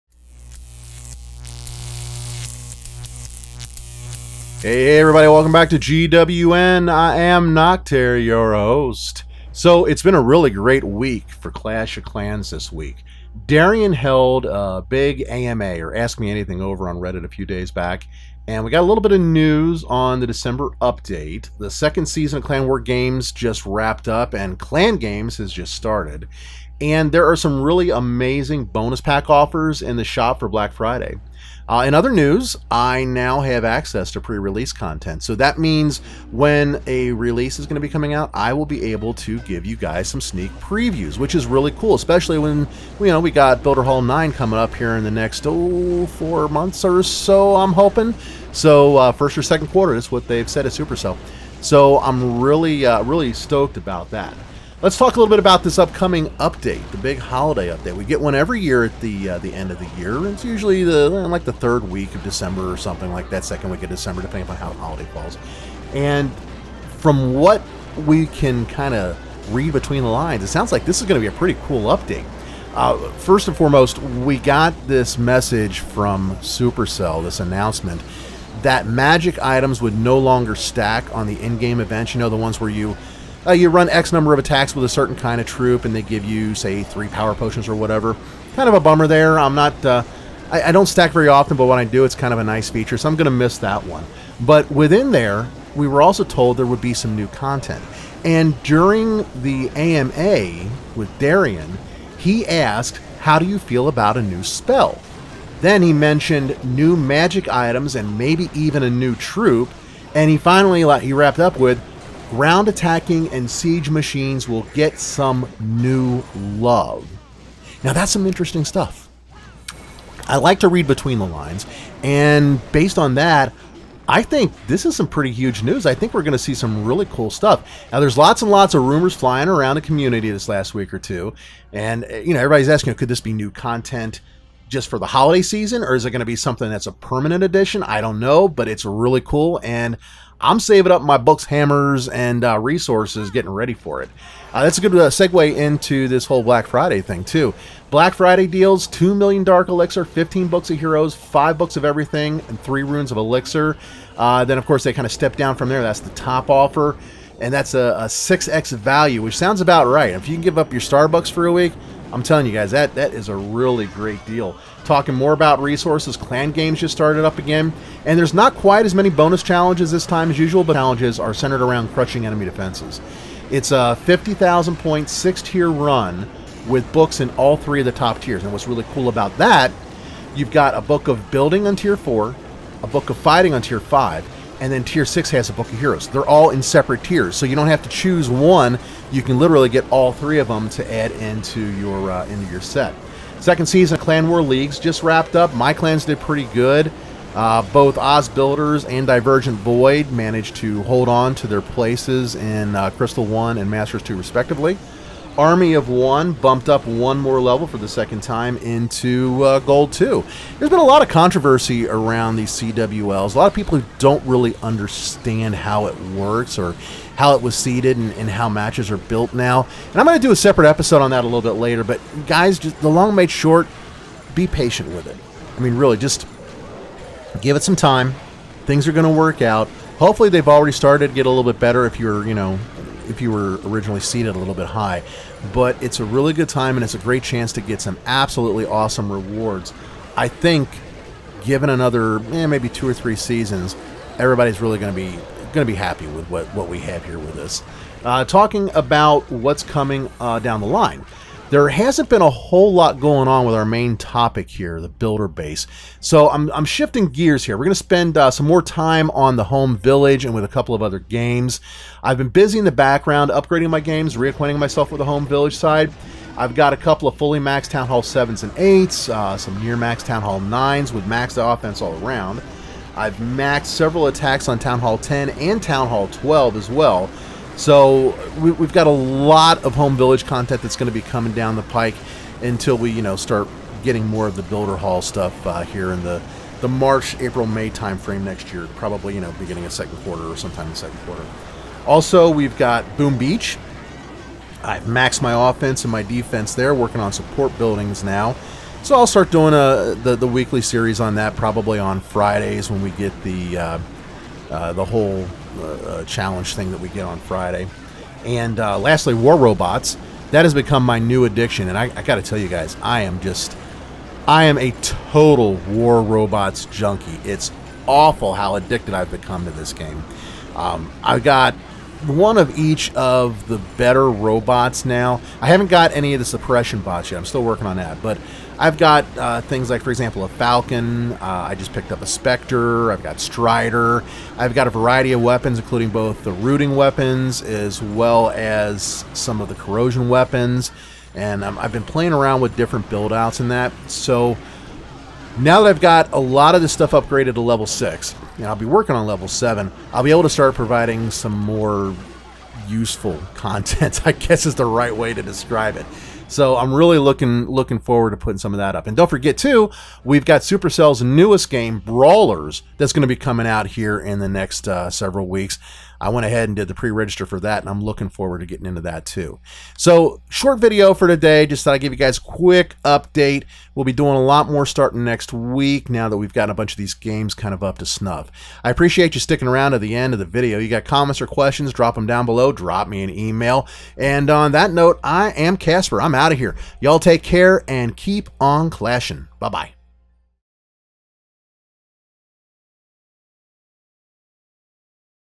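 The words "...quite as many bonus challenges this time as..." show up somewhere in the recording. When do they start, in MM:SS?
02:48.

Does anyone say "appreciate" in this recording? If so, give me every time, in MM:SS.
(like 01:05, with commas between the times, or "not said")
06:18.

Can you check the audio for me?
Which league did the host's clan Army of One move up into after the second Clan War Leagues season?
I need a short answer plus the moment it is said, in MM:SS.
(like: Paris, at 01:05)
Gold 2, at 03:29.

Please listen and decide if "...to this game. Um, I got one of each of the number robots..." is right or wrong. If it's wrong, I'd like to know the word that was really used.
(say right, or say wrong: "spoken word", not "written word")
wrong: "better", not "number".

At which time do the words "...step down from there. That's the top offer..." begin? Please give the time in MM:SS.
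02:35.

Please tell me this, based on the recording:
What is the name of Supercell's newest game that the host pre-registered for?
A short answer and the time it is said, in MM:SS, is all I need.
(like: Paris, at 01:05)
Brawl Stars, at 06:01.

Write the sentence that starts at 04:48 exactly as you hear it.
Probably, you know, beginning of second quarter or sometime in second quarter.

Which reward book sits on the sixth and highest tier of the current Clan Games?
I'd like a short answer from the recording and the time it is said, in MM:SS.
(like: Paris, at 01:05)
Book of Heroes, at 03:05.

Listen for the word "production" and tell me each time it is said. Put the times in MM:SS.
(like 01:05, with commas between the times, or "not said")
not said.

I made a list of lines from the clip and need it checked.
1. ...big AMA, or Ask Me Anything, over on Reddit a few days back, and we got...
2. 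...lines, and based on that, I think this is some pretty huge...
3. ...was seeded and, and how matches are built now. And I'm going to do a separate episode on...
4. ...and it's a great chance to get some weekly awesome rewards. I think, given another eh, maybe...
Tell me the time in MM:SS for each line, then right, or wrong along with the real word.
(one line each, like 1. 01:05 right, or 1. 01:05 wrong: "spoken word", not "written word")
1. 00:14 right
2. 02:01 right
3. 03:37 right
4. 03:56 wrong: "absolutely", not "weekly".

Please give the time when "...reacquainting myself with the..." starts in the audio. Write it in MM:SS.
04:24.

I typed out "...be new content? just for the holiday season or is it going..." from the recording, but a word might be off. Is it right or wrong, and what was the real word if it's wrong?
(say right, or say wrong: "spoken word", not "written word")
right.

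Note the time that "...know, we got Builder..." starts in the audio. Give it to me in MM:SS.
00:43.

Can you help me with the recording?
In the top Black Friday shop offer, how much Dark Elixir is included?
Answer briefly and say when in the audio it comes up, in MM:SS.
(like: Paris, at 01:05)
2 million, at 02:28.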